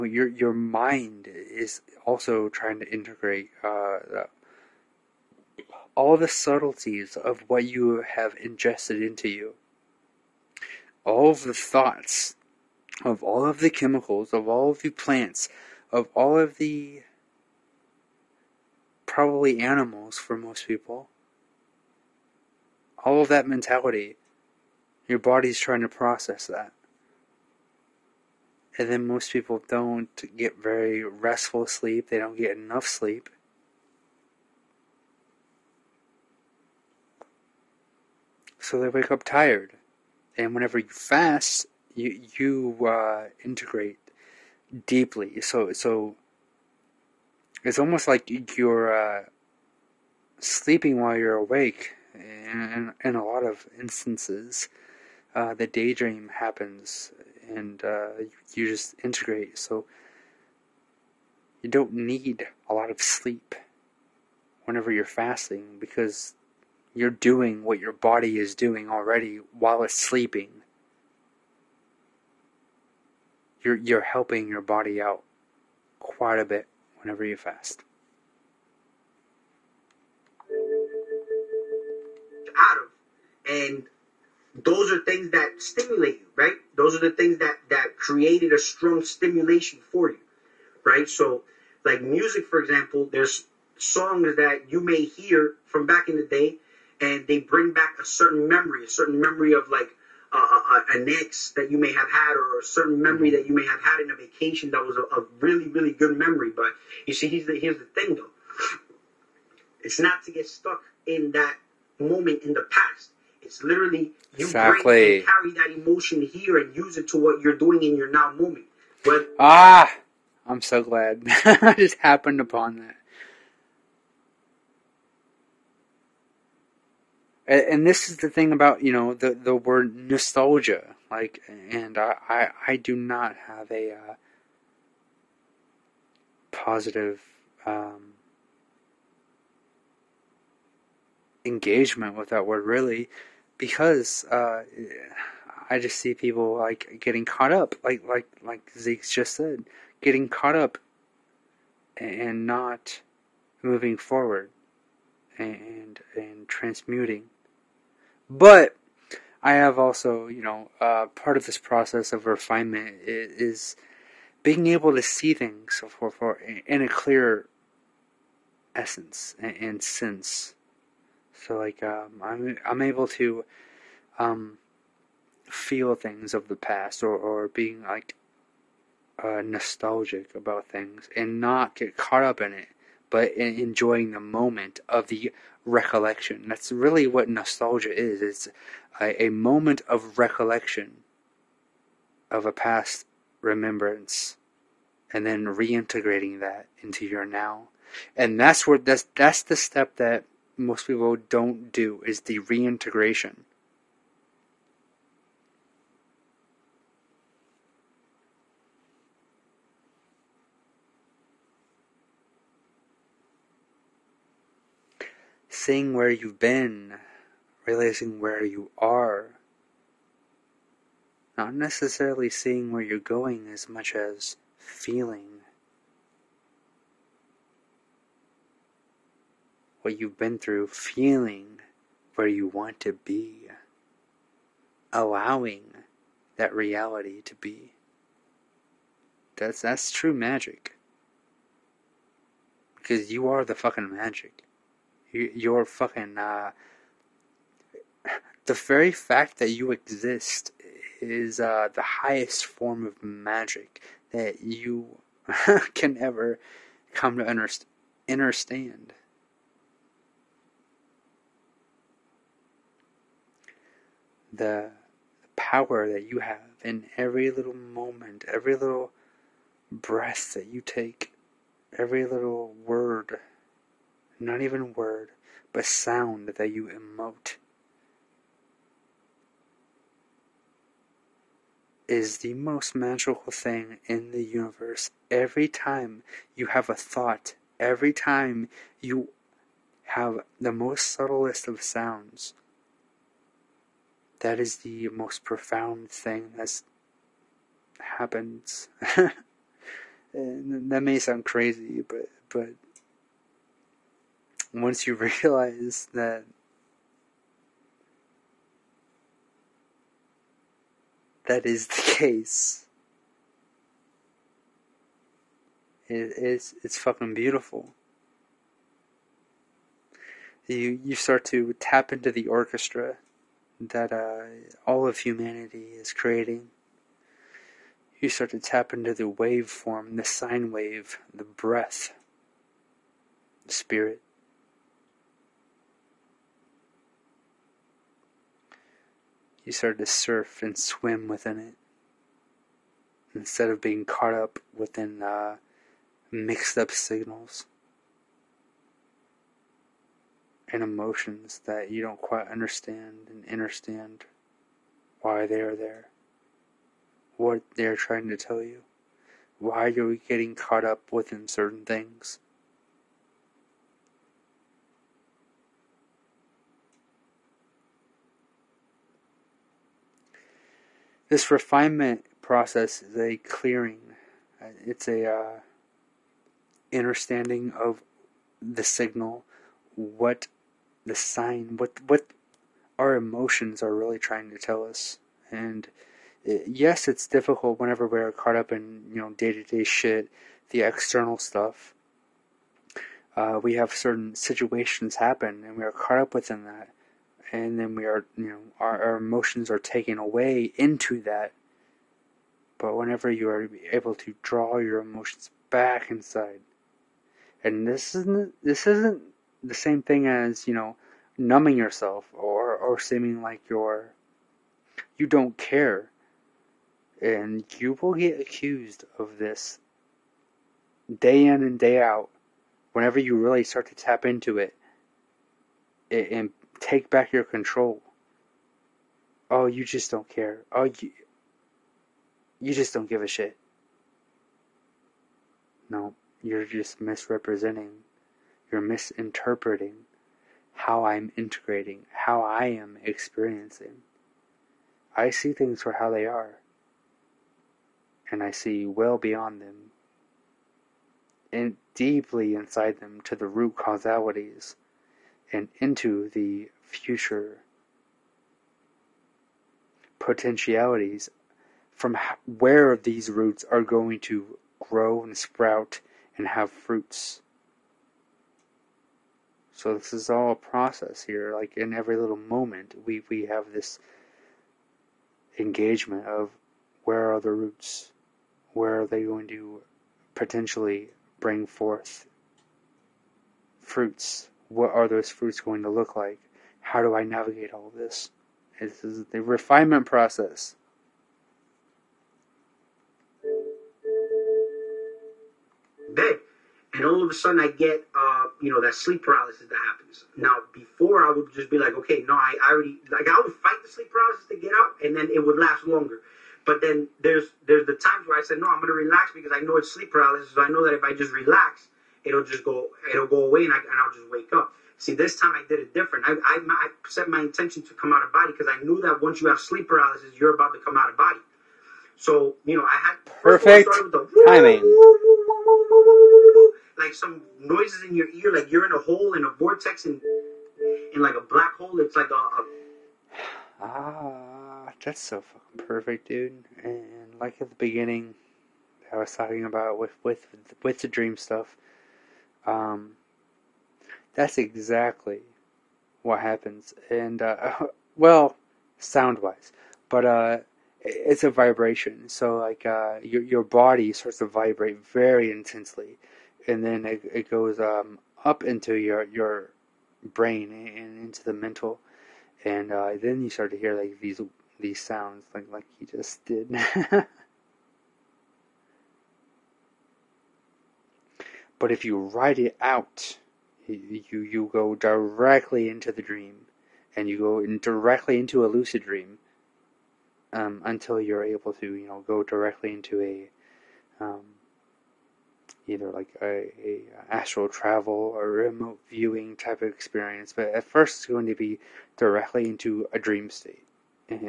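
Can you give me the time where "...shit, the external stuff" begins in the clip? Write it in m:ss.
6:29.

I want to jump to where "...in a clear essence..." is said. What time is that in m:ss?
2:46.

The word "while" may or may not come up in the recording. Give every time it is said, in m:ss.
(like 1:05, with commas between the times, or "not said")
0:51, 1:09.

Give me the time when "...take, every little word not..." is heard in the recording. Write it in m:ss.
4:30.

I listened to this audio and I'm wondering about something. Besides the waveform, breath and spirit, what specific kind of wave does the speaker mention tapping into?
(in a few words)
Sine wave.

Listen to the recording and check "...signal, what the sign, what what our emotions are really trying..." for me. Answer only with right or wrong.
right.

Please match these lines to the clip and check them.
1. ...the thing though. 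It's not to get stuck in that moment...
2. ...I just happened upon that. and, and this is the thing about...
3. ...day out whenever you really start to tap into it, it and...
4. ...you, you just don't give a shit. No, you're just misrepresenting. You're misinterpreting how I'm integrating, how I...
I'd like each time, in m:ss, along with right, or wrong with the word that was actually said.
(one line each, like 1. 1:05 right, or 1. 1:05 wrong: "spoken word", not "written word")
1. 1:47 right
2. 2:01 right
3. 7:01 right
4. 7:10 right.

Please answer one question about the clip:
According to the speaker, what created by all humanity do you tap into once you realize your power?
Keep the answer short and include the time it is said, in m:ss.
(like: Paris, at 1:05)
The orchestra, at 5:22.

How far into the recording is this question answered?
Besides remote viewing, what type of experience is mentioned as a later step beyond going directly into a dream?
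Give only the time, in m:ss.
9:47.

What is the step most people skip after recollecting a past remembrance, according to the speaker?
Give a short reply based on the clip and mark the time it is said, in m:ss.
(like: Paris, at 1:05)
Reintegration, at 3:22.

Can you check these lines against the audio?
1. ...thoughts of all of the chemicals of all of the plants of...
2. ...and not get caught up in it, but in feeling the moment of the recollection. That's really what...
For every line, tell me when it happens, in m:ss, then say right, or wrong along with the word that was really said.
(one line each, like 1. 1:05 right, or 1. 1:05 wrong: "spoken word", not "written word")
1. 0:11 right
2. 3:01 wrong: "enjoying", not "feeling".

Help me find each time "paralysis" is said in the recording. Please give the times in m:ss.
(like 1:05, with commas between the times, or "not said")
8:19, 8:23, 8:29, 8:39.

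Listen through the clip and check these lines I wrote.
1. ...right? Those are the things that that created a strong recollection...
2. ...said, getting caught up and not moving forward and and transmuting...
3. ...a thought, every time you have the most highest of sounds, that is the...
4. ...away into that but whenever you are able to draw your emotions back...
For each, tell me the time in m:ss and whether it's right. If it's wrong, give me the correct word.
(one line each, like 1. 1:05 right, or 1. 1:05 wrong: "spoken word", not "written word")
1. 1:26 wrong: "stimulation", not "recollection"
2. 2:29 right
3. 4:46 wrong: "subtlest", not "highest"
4. 6:39 right.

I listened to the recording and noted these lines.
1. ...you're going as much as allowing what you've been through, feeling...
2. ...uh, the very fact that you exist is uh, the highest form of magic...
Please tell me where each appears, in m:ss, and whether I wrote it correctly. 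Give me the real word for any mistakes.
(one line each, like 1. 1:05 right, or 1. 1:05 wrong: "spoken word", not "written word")
1. 3:42 wrong: "feeling", not "allowing"
2. 4:06 right.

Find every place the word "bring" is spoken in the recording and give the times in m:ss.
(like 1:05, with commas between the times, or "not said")
1:37, 8:01.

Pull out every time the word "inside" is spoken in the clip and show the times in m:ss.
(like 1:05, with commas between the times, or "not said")
6:45, 7:32.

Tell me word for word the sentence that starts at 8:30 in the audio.
So I know that if I just relax, it'll just go it'll go away and, I, and I'll just wake up.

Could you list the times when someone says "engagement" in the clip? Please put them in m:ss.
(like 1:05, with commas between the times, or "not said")
2:21, 7:55.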